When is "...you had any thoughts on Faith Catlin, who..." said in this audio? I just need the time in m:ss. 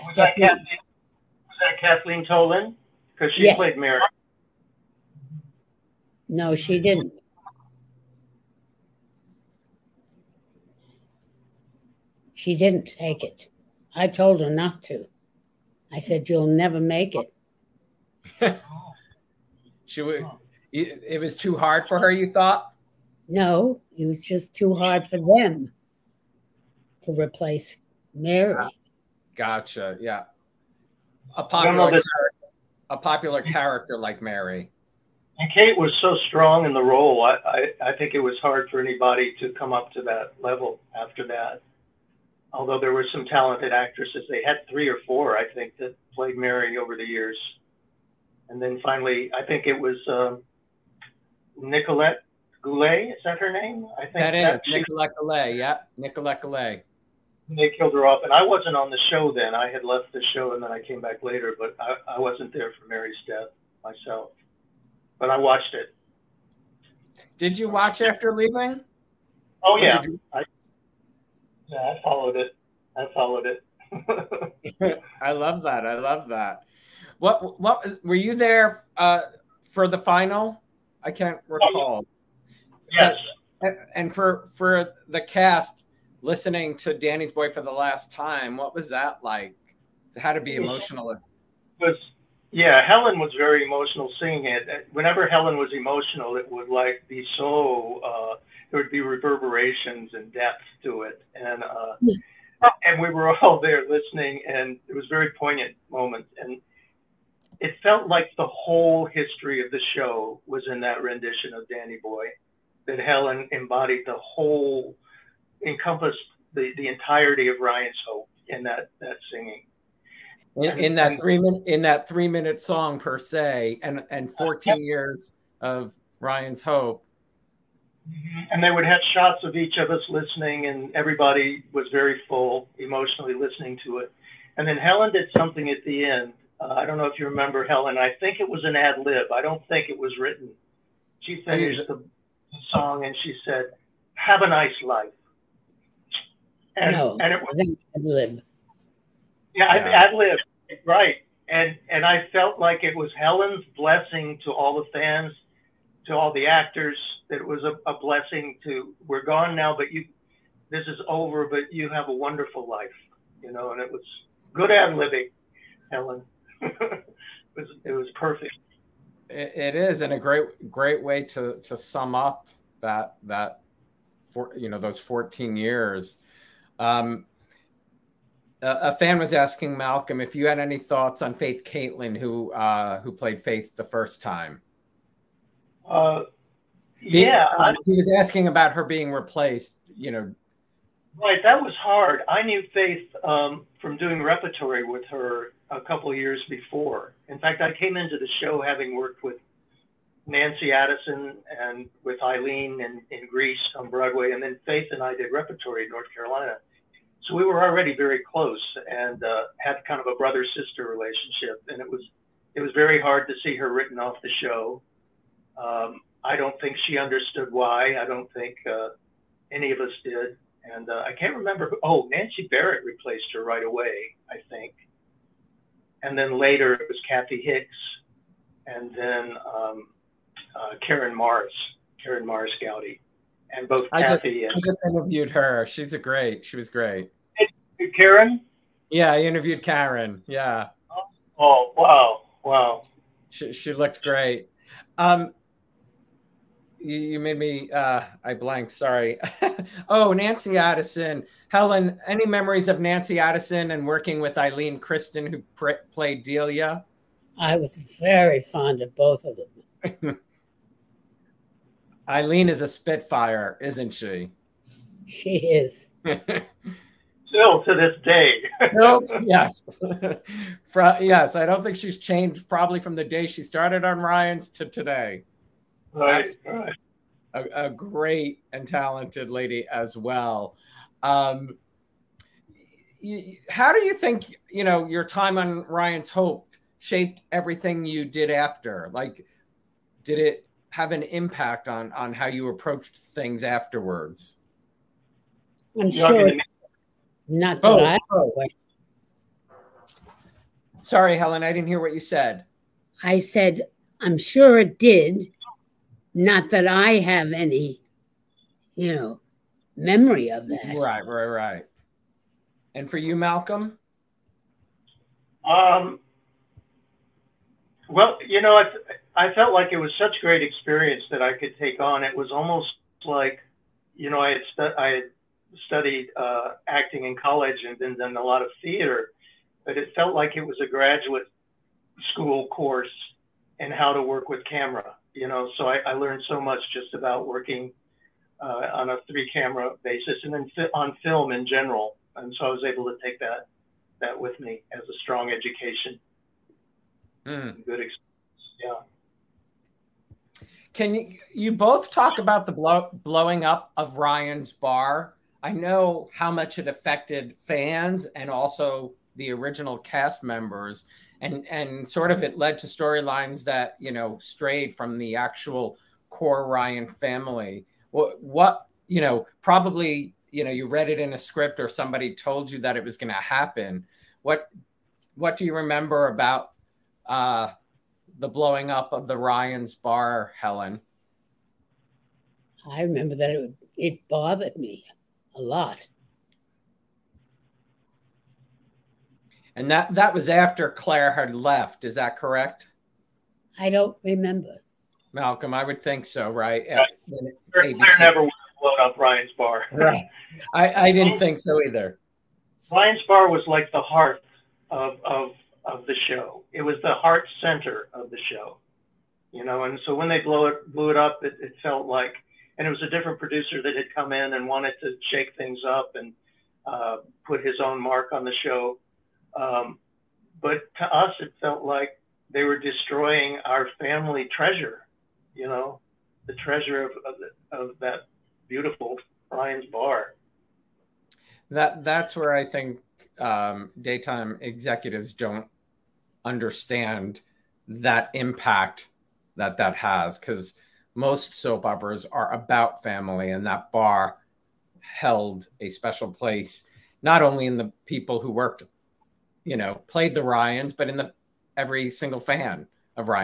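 3:00.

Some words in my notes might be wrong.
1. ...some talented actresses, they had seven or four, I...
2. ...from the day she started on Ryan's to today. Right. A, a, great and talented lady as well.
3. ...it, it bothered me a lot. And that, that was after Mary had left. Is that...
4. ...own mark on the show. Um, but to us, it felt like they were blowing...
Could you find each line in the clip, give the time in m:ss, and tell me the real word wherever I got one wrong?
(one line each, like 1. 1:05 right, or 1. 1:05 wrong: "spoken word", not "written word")
1. 0:43 wrong: "three", not "seven"
2. 4:32 right
3. 6:23 wrong: "Claire", not "Mary"
4. 6:57 wrong: "destroying", not "blowing".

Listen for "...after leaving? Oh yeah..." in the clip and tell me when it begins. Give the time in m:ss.
1:08.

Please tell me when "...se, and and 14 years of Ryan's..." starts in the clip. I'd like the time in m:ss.
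2:03.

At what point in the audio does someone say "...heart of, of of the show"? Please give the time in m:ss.
6:43.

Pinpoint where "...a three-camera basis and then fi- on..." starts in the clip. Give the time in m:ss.
5:38.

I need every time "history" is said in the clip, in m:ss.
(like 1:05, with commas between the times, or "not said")
1:49.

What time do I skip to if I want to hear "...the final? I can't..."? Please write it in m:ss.
1:19.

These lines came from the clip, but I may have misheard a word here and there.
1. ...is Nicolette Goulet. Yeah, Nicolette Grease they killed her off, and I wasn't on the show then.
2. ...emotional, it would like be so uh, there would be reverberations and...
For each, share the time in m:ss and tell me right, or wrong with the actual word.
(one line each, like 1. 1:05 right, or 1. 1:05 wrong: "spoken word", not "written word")
1. 0:54 wrong: "Goulet", not "Grease"
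2. 1:35 right.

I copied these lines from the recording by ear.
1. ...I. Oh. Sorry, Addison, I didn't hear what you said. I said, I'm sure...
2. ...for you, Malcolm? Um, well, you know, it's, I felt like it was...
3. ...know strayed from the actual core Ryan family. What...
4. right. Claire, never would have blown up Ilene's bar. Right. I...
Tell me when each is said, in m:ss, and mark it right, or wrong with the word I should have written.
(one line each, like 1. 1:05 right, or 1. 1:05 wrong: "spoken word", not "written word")
1. 4:58 wrong: "Helen", not "Addison"
2. 5:12 right
3. 6:03 right
4. 6:36 wrong: "Ryan", not "Ilene".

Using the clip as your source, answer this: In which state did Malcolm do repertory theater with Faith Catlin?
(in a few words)
North Carolina.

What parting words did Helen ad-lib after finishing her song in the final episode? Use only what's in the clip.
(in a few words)
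Have a nice life.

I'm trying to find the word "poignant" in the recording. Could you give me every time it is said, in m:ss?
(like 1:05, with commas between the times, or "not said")
1:45.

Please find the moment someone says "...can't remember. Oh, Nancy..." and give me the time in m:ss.
3:41.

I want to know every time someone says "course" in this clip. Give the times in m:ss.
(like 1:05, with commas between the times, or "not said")
5:32.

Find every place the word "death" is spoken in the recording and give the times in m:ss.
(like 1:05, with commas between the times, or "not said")
1:03.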